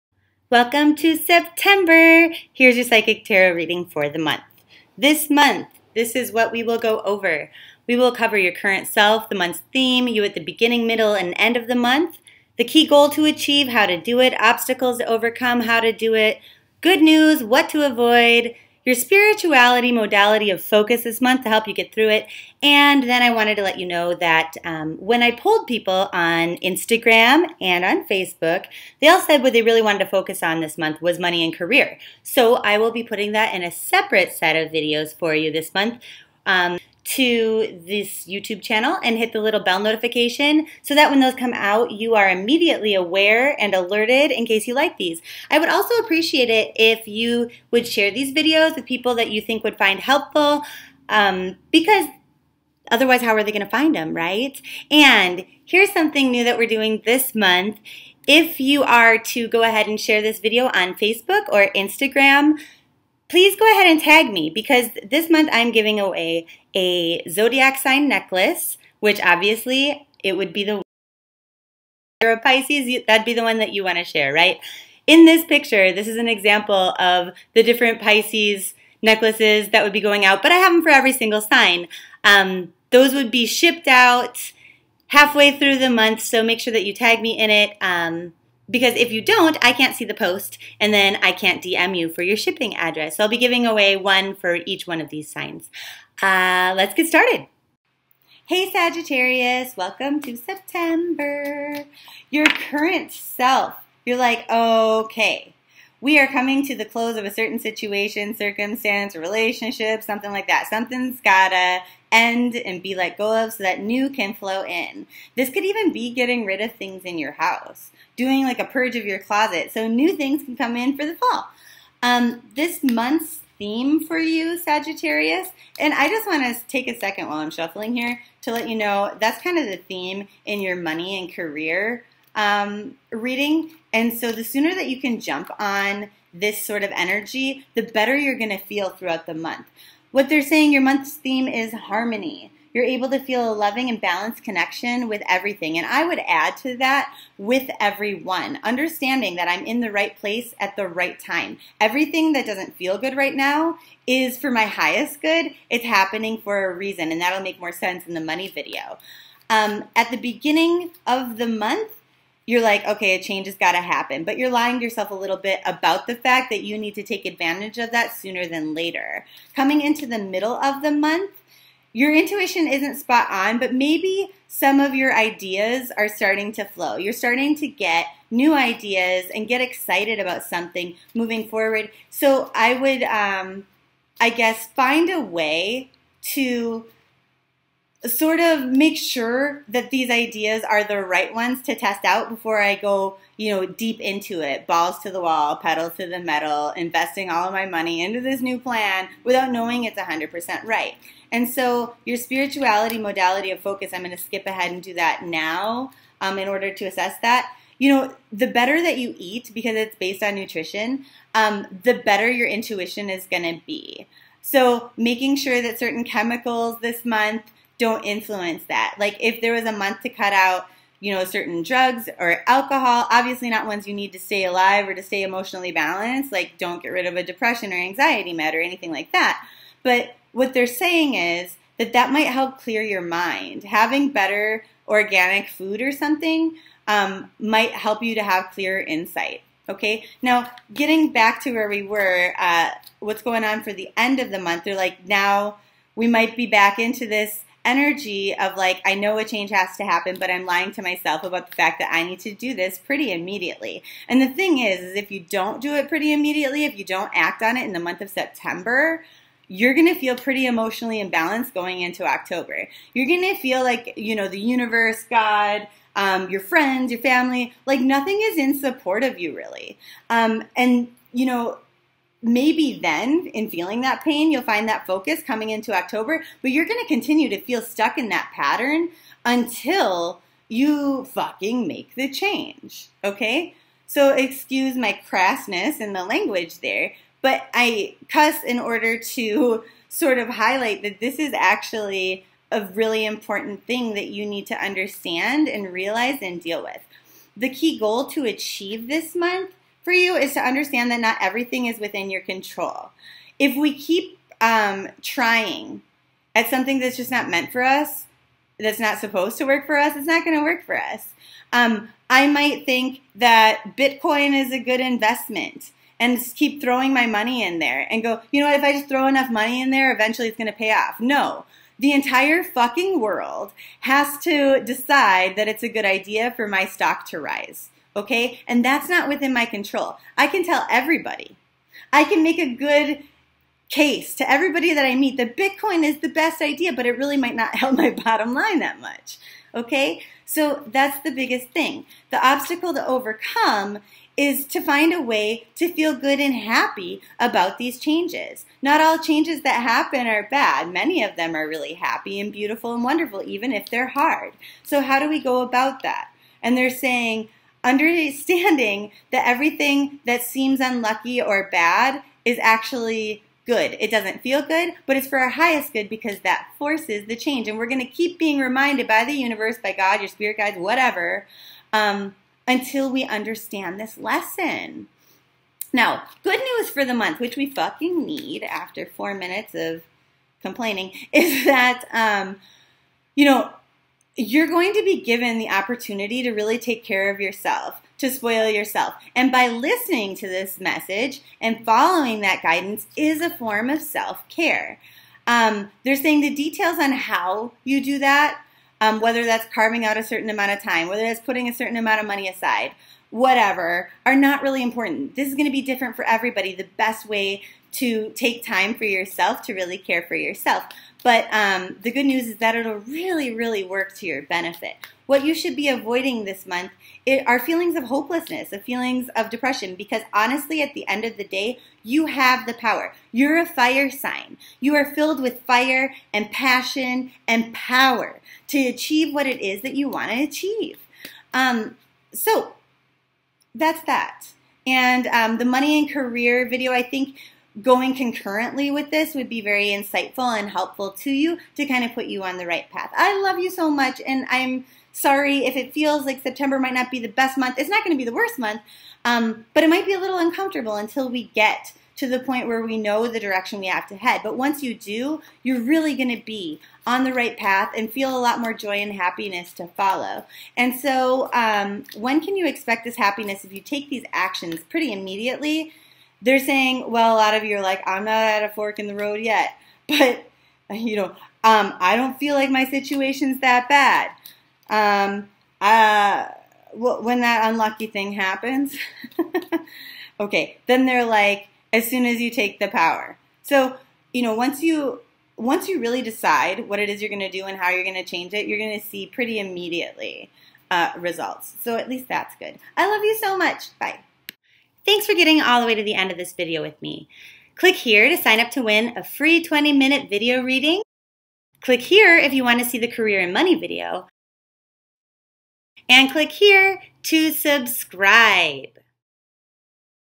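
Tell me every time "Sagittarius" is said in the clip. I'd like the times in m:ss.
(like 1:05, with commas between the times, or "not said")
1:38, 2:04.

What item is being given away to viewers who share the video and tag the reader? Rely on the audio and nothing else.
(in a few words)
zodiac sign necklace.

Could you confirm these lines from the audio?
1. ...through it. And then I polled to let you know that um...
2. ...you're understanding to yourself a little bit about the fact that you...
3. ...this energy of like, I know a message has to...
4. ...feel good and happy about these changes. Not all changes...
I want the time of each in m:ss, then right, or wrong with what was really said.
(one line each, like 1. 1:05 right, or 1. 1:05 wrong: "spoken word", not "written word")
1. 0:21 wrong: "wanted", not "polled"
2. 2:44 wrong: "lying", not "understanding"
3. 4:07 wrong: "change", not "message"
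4. 5:45 right.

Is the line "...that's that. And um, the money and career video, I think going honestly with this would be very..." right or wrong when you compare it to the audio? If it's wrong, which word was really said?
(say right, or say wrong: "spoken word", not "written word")
wrong: "concurrently", not "honestly".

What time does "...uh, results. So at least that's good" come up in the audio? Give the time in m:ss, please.
8:10.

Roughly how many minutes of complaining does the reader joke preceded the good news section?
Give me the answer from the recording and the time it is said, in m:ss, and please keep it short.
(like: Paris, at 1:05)
4, at 6:18.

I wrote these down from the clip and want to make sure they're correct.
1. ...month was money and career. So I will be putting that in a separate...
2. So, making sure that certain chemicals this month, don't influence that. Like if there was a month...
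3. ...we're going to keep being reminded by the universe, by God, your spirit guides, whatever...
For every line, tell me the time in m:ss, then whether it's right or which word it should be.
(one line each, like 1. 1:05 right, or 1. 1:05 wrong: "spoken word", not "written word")
1. 0:30 right
2. 3:34 right
3. 6:07 right.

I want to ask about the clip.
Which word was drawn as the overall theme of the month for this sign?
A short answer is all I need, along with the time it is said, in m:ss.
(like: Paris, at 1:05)
harmony, at 2:21.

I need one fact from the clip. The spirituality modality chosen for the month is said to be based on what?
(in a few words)
nutrition.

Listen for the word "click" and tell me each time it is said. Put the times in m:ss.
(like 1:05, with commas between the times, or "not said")
8:17, 8:21, 8:26.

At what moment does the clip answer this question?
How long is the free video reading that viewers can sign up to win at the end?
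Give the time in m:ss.
8:19.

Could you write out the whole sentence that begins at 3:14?
Balls to the wall, pedal to the metal, investing all of my money into this new plan without knowing it's 100% right.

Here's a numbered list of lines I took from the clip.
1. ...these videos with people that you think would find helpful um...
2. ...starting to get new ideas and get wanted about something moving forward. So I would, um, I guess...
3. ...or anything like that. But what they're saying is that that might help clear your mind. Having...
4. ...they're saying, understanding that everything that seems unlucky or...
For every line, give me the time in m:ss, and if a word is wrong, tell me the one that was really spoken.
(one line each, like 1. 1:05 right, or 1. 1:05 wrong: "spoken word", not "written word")
1. 0:48 right
2. 2:57 wrong: "excited", not "wanted"
3. 3:48 right
4. 5:56 right.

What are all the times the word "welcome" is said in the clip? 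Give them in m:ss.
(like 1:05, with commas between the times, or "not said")
0:00, 1:39.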